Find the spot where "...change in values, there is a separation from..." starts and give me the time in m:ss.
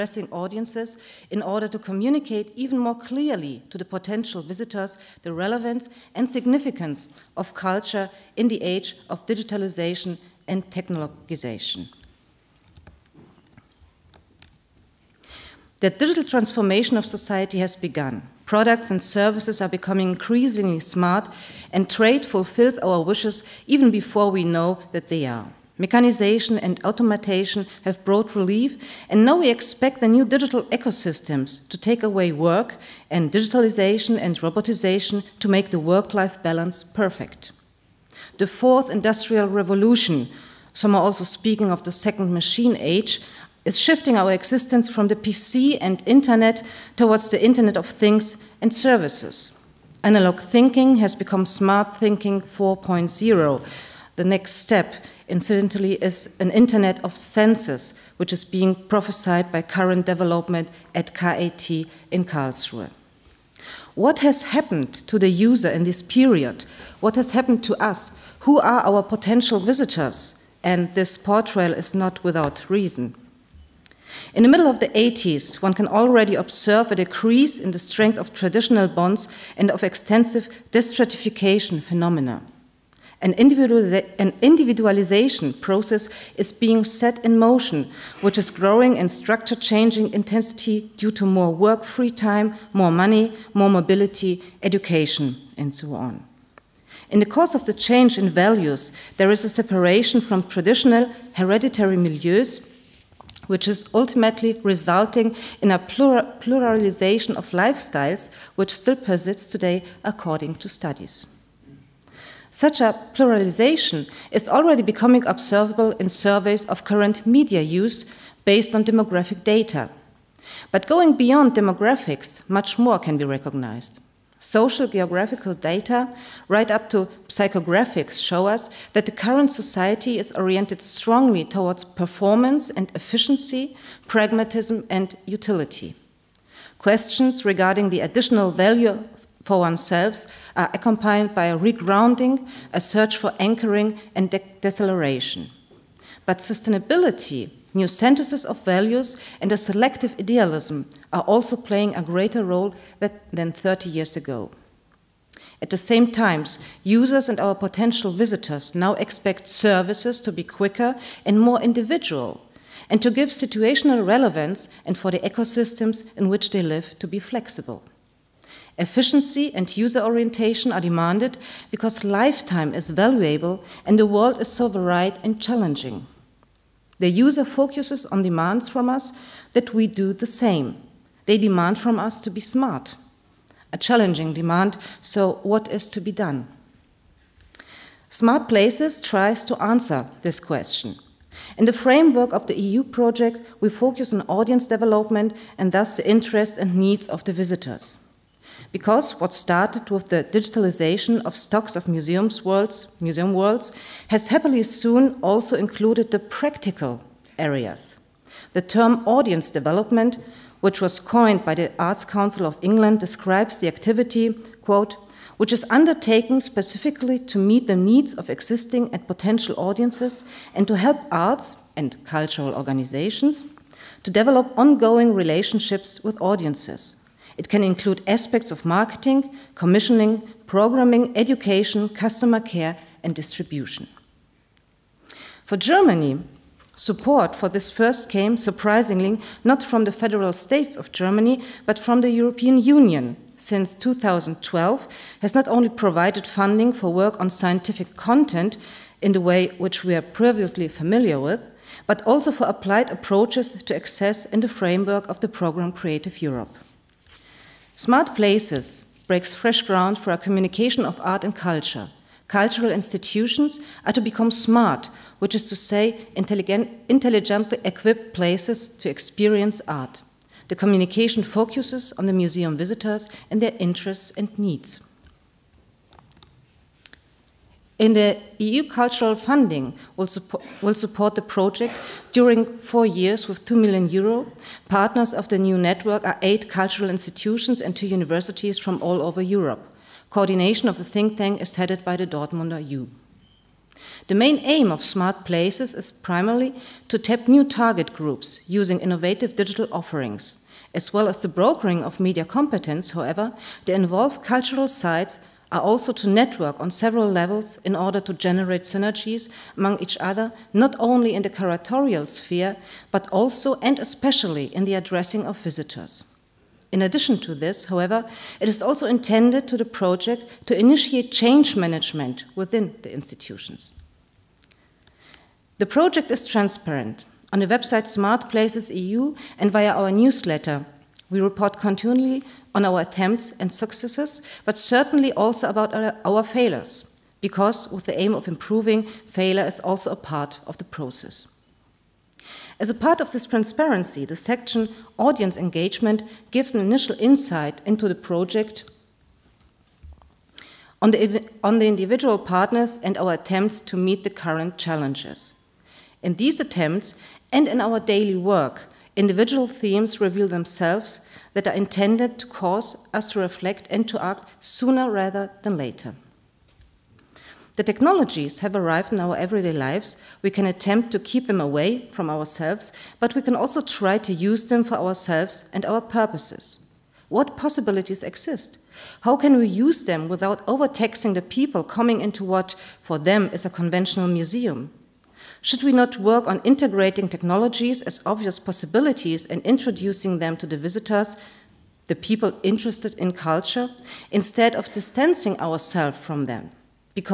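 1:37.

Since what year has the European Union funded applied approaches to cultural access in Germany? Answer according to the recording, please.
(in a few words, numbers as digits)
2012.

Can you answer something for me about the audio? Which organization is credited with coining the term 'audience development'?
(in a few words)
Arts Council of England.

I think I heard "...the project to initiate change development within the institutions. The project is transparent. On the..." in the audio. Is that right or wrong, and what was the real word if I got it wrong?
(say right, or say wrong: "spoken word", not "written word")
wrong: "management", not "development".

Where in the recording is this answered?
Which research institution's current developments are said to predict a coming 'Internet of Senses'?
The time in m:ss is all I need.
1:01.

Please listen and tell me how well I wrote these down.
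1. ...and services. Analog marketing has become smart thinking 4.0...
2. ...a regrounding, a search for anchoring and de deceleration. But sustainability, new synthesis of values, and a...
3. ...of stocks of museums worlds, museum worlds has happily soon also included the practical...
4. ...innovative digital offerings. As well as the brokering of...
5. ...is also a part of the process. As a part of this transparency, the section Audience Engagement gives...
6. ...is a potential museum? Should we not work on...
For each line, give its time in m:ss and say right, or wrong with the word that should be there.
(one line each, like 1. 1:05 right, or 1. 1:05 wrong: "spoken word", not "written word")
1. 0:48 wrong: "thinking", not "marketing"
2. 2:21 right
3. 3:21 right
4. 4:58 right
5. 5:39 right
6. 6:23 wrong: "conventional", not "potential".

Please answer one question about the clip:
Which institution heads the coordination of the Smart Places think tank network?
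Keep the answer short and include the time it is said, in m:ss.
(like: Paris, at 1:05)
Dortmunder U, at 4:52.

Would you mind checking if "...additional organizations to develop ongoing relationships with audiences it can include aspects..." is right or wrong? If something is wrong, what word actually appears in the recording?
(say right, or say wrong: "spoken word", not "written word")
wrong: "cultural", not "additional".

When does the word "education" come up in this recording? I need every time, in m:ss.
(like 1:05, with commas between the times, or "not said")
1:34, 3:51.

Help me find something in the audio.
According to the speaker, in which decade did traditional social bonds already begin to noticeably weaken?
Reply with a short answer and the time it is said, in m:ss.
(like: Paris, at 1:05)
80s, at 1:14.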